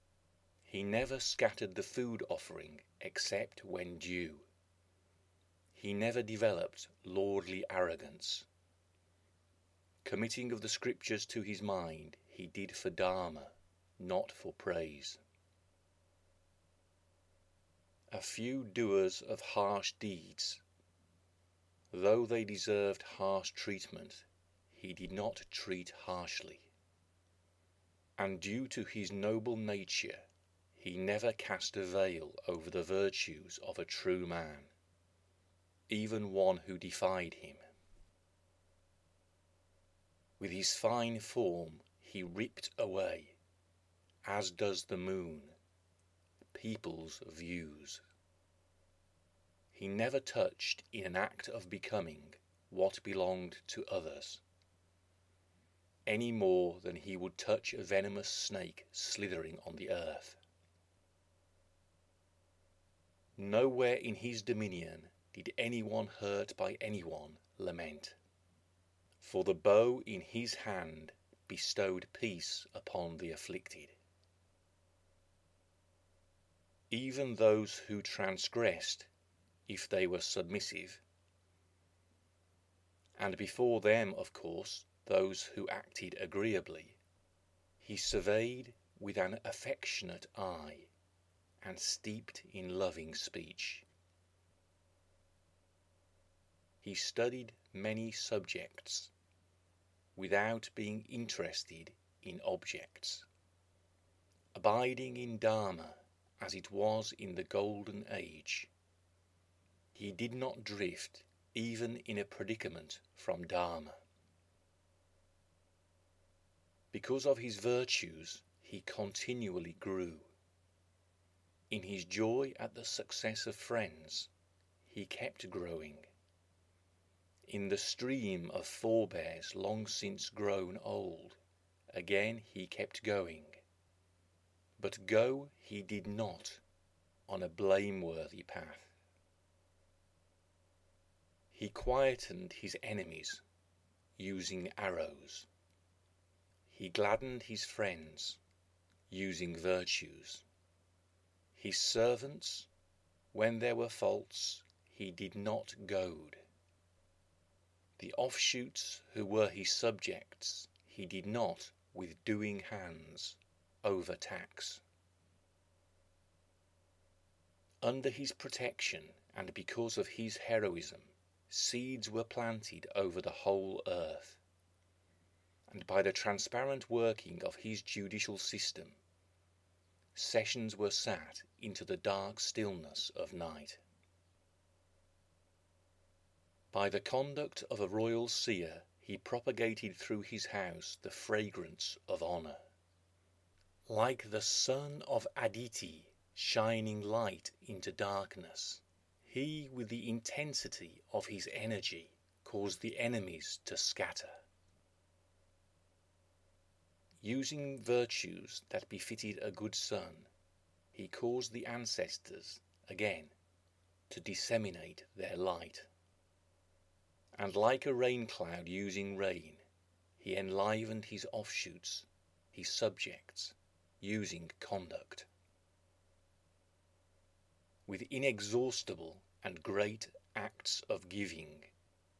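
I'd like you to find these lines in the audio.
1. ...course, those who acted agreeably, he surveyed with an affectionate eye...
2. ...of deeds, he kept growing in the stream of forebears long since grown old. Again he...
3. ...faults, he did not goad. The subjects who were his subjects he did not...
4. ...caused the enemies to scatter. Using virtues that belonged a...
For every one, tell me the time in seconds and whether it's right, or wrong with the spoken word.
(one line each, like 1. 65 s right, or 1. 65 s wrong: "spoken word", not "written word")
1. 84 s right
2. 123 s wrong: "friends", not "deeds"
3. 153 s wrong: "offshoots", not "subjects"
4. 202 s wrong: "befitted", not "belonged".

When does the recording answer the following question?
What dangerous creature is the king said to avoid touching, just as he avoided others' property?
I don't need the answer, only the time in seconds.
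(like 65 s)
57 s.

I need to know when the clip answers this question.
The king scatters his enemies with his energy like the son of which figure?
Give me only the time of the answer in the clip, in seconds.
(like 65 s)
195 s.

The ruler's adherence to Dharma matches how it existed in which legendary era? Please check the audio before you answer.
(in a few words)
The Golden Age.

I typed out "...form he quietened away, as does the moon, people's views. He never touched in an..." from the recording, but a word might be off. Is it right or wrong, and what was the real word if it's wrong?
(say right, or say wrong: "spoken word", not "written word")
wrong: "ripped", not "quietened".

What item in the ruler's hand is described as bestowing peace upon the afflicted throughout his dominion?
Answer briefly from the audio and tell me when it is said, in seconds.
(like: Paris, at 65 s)
The bow, at 69 s.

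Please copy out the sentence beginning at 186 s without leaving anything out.
By the conduct of a royal seer, he propagated through his house the fragrance of honor.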